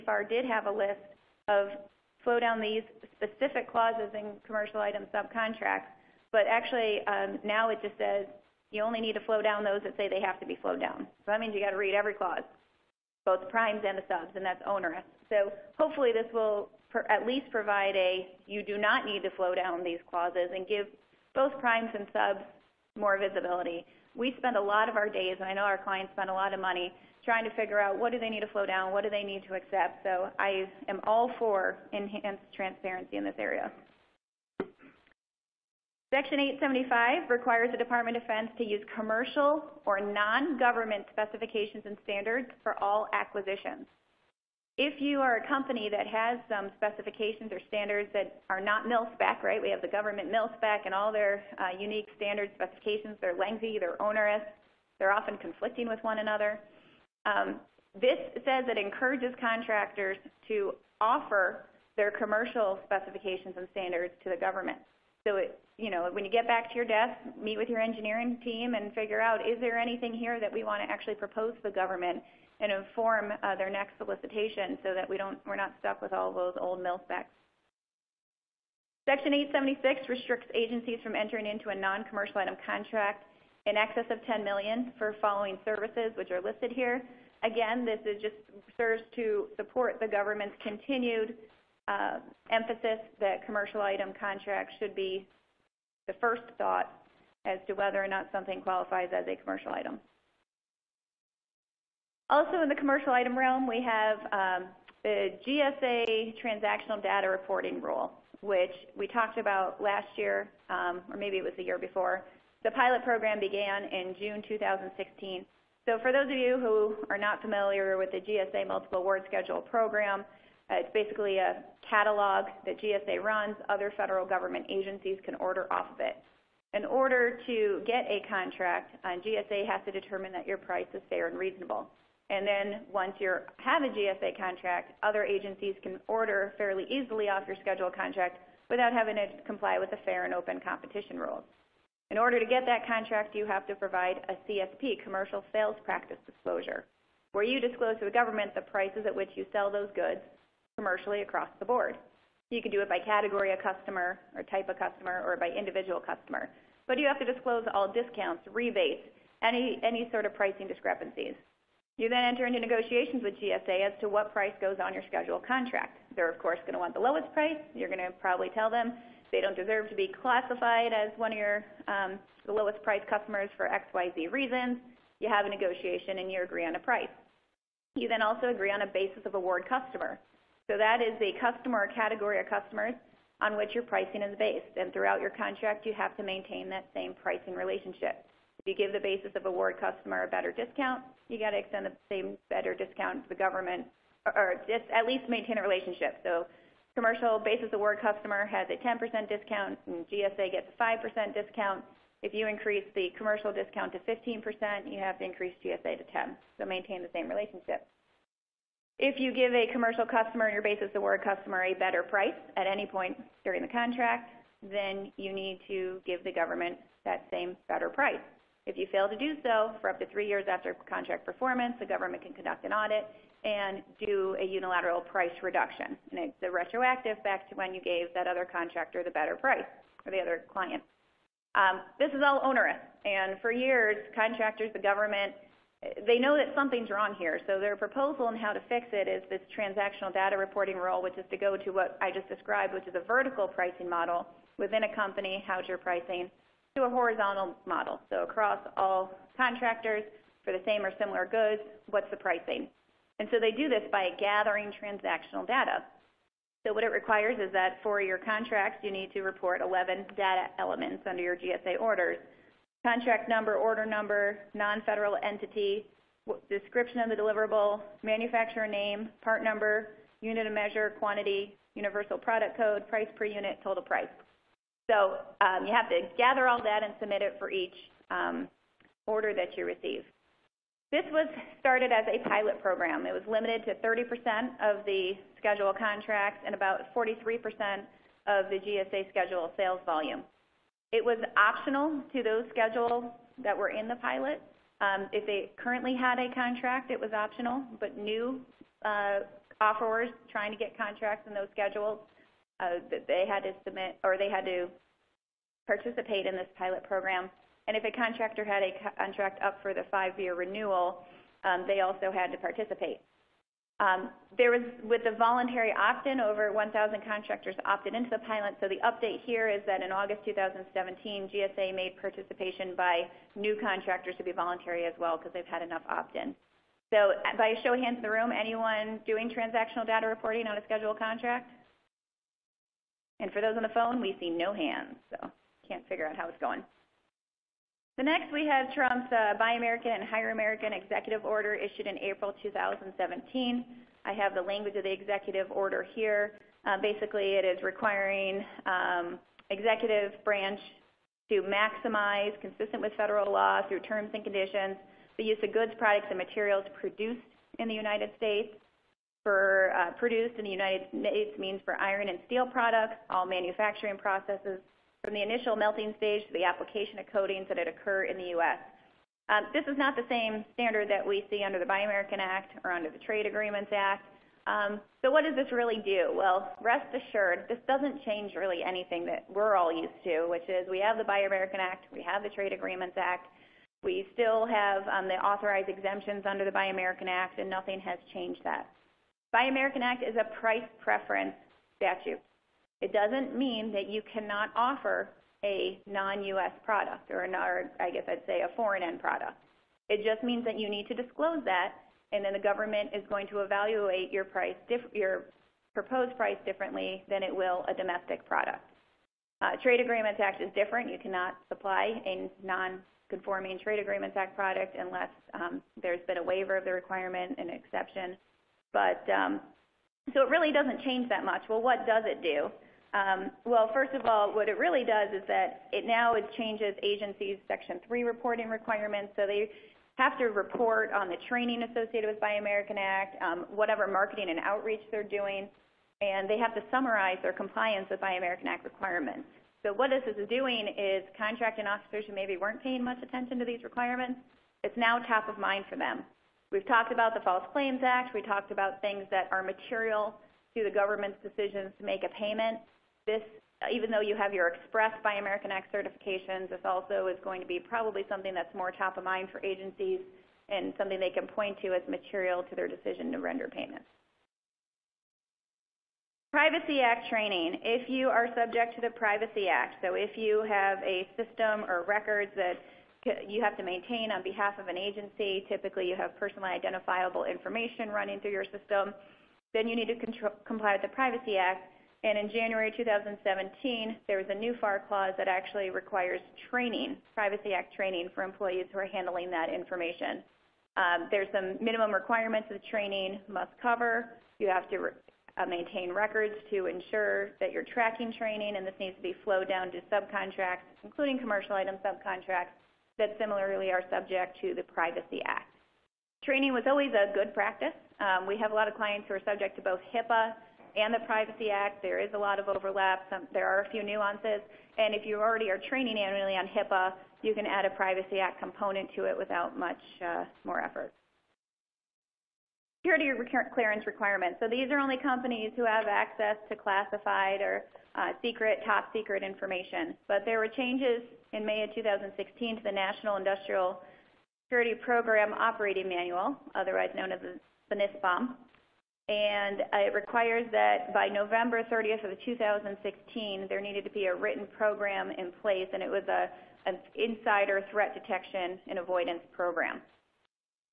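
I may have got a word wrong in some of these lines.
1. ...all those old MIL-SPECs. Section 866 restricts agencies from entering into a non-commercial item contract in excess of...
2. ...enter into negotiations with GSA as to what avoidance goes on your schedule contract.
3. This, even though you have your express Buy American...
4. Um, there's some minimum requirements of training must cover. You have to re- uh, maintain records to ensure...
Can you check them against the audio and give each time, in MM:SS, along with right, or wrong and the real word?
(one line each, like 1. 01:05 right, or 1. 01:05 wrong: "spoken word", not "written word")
1. 01:16 wrong: "876", not "866"
2. 02:42 wrong: "price", not "avoidance"
3. 07:33 right
4. 08:10 right.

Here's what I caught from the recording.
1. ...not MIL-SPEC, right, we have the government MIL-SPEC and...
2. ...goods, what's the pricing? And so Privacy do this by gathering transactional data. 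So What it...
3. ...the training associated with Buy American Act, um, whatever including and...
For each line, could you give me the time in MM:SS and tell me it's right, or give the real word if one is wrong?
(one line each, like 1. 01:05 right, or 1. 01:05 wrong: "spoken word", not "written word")
1. 00:48 right
2. 04:11 wrong: "They", not "Privacy"
3. 07:11 wrong: "marketing", not "including".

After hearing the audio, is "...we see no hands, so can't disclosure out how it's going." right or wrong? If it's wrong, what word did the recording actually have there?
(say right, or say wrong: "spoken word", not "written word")
wrong: "figure", not "disclosure".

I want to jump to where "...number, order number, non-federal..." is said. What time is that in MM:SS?
04:23.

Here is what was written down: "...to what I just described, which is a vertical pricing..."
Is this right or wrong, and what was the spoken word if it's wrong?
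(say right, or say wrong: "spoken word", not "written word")
right.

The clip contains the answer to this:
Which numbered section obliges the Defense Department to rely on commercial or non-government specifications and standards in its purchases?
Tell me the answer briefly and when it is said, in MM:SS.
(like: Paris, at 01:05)
Section 875, at 00:36.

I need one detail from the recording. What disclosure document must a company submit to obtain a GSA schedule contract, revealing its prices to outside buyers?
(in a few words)
commercial sales practice disclosure.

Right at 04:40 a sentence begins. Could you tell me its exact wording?
This was started as a pilot program.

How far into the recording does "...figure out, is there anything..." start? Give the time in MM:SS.
01:08.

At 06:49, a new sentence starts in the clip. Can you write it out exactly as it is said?
Uh, Trade Agreements Act is different.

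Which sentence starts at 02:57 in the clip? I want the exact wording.
You then also agree on a basis of award customer.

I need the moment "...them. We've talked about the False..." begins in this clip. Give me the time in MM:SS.
07:25.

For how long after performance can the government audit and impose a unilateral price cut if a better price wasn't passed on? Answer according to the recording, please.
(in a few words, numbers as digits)
3 years.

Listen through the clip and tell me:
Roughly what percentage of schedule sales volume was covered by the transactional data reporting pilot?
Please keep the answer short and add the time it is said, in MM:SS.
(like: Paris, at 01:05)
43%, at 04:46.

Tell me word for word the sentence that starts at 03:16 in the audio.
So commercial basis award customer has a 10% discount, and GSA gets a 5% discount.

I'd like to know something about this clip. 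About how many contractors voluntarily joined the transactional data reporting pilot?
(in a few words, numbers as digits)
over 1,000.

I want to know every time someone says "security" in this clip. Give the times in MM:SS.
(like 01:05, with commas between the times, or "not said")
08:42, 08:54.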